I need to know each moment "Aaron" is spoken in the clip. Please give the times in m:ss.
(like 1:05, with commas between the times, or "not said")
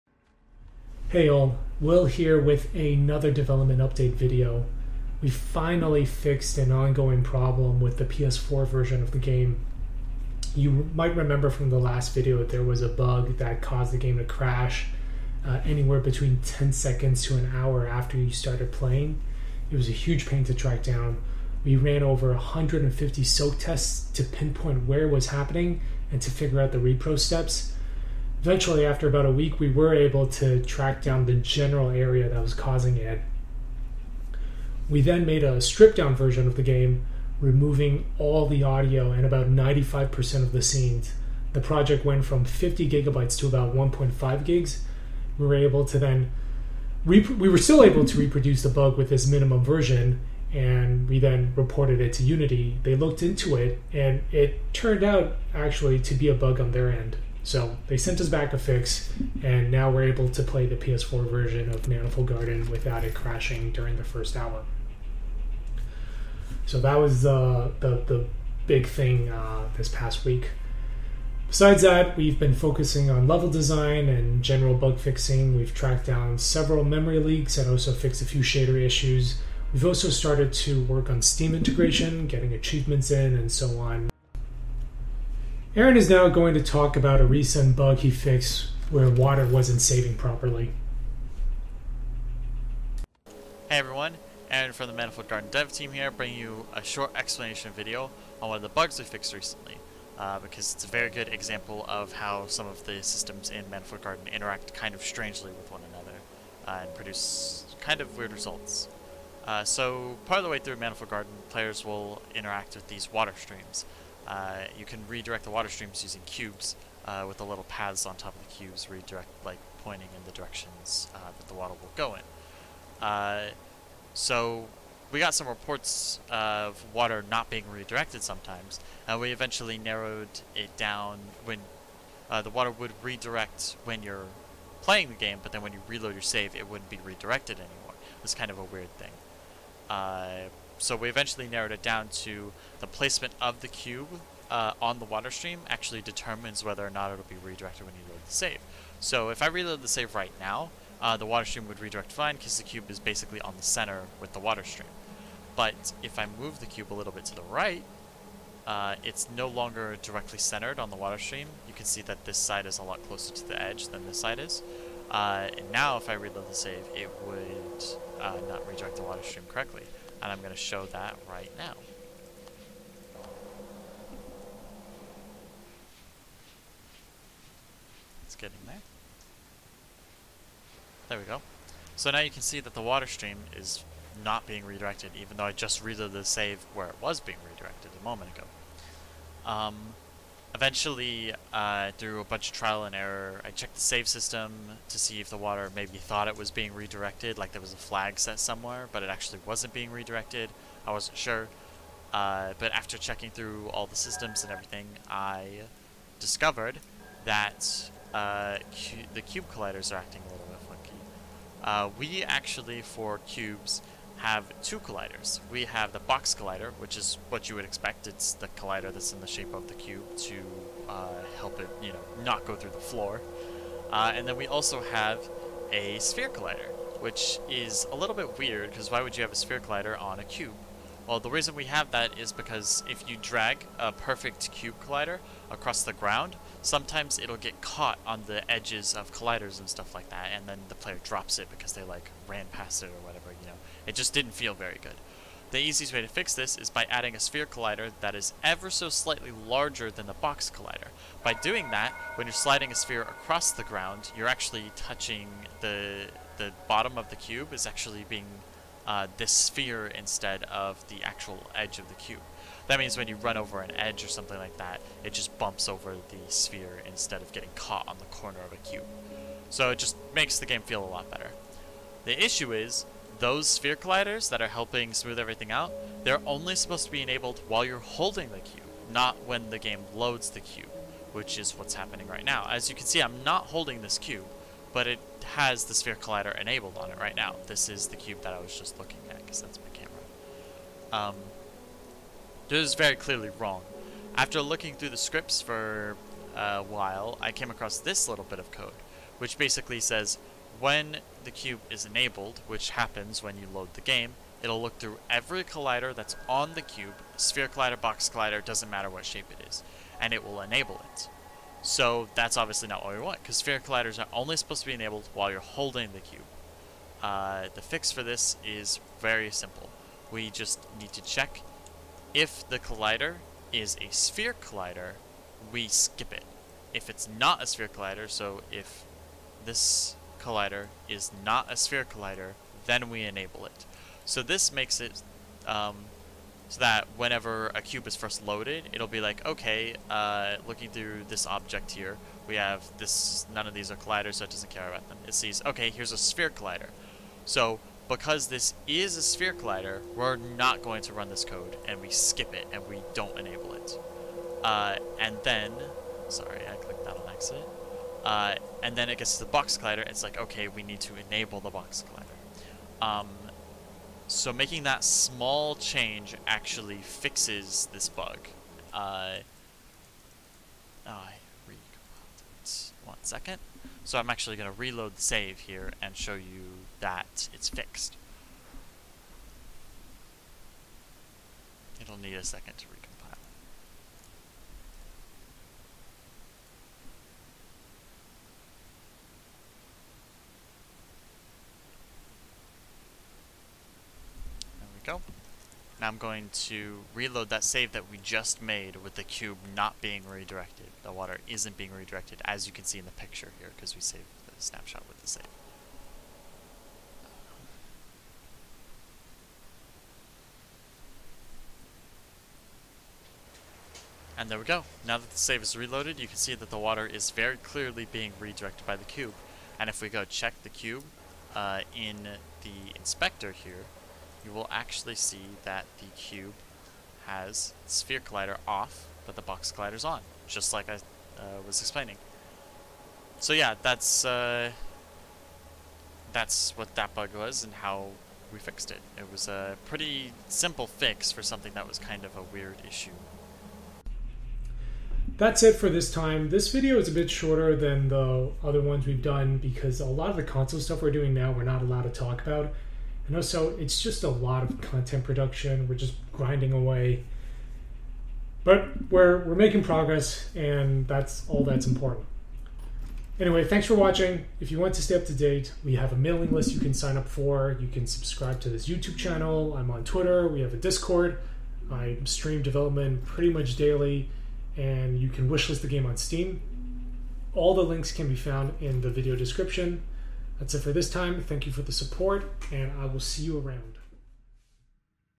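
1:25, 1:34.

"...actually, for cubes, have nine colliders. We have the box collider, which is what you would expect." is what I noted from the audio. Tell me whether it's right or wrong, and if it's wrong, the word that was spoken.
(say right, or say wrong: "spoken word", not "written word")
wrong: "two", not "nine".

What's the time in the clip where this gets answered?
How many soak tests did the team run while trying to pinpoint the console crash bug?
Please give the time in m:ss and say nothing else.
0:22.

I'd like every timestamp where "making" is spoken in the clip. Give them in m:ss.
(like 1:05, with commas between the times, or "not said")
6:04, 7:39.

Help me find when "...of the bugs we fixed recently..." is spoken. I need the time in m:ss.
1:38.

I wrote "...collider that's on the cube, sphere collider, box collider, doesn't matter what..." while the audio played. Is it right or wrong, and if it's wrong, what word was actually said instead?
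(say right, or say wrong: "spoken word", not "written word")
right.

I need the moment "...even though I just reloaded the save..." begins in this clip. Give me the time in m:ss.
3:05.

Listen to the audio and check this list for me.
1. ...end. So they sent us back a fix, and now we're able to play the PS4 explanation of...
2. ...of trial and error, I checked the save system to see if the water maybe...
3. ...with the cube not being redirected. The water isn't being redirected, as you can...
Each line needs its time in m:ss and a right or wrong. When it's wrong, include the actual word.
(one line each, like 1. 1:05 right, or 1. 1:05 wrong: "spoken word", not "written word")
1. 0:56 wrong: "version", not "explanation"
2. 3:12 right
3. 6:38 right.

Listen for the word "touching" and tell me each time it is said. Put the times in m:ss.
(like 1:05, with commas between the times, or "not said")
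4:14.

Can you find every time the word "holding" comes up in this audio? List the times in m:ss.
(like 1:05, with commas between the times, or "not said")
4:37, 4:43, 5:15.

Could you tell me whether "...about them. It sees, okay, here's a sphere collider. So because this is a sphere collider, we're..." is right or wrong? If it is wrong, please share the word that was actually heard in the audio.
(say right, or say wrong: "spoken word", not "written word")
right.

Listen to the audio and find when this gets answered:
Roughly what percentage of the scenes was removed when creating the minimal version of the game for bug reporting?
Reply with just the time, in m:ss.
0:39.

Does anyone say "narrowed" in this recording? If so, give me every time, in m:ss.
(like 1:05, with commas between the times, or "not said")
2:09, 2:21.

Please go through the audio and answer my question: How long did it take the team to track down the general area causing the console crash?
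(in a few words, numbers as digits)
About a week.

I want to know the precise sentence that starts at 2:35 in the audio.
But if I move the cube a little bit to the right, uh, it's no longer directly centered on the water stream.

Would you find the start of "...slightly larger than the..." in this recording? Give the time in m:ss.
4:08.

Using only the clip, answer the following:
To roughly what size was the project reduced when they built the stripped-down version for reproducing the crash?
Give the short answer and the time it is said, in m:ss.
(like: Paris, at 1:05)
1.5 gigs, at 0:43.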